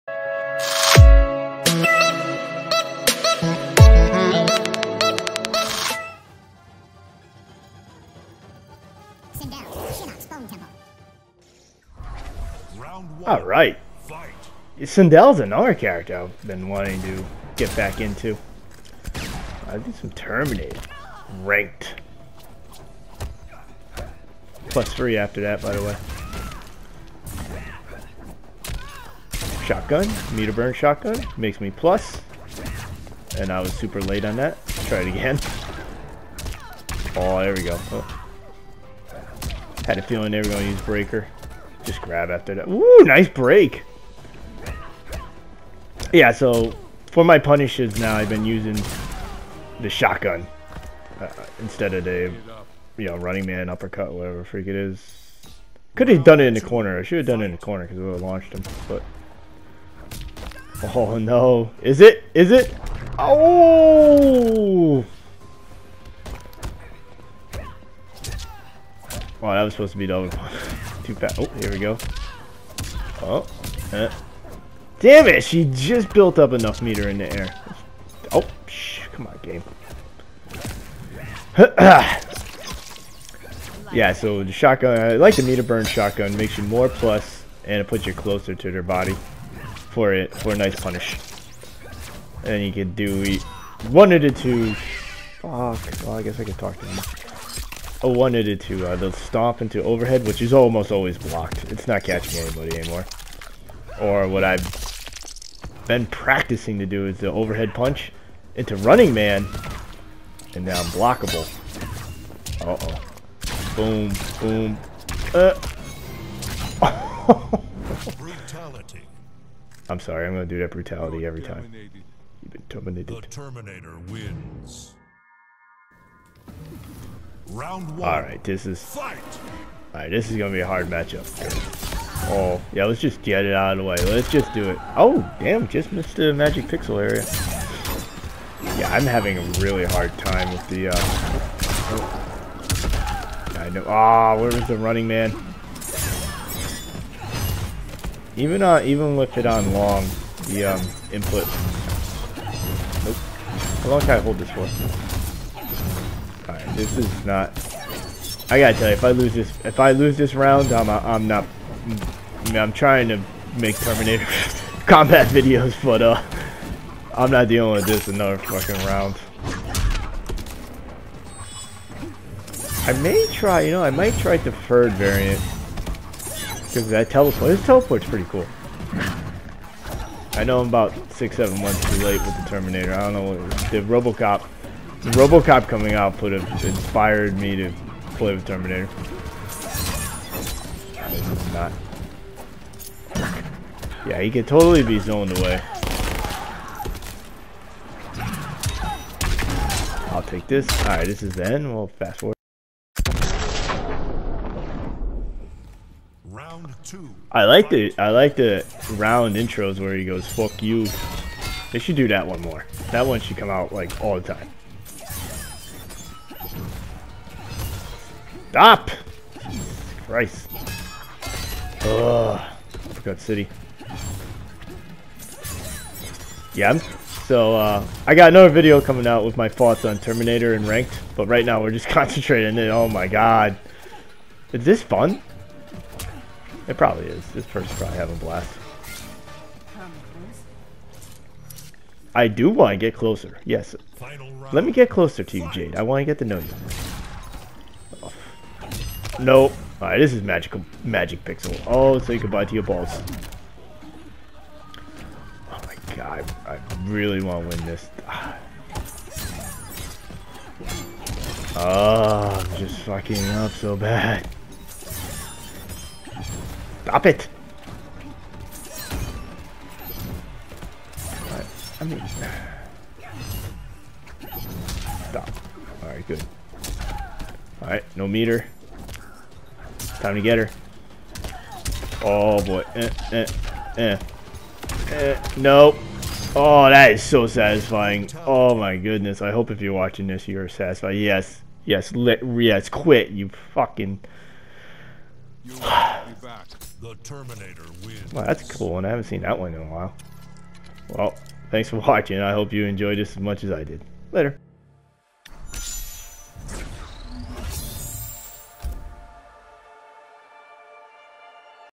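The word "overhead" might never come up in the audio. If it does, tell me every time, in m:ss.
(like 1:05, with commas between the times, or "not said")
1:39, 1:47.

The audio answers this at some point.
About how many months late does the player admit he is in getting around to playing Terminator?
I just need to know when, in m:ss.
3:01.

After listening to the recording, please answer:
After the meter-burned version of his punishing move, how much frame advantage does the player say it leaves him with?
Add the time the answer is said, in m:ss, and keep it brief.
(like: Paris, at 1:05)
+3, at 0:24.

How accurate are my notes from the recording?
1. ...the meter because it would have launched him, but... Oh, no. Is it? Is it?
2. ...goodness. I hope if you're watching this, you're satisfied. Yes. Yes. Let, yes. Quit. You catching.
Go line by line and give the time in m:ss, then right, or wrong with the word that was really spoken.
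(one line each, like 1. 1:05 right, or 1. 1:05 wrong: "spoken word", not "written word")
1. 0:57 wrong: "corner", not "meter"
2. 4:48 wrong: "fucking", not "catching".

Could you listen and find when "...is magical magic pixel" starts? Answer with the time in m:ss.
4:10.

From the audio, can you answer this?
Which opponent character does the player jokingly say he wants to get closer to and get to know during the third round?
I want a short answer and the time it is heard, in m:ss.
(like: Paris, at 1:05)
Jade, at 4:05.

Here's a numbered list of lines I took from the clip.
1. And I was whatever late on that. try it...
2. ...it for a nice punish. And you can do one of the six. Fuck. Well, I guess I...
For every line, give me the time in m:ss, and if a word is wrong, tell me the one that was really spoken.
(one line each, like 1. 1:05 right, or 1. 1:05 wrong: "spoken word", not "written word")
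1. 0:33 wrong: "super", not "whatever"
2. 1:30 wrong: "two", not "six".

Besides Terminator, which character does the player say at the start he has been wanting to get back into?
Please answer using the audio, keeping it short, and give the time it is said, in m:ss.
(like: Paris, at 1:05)
Sindel, at 0:14.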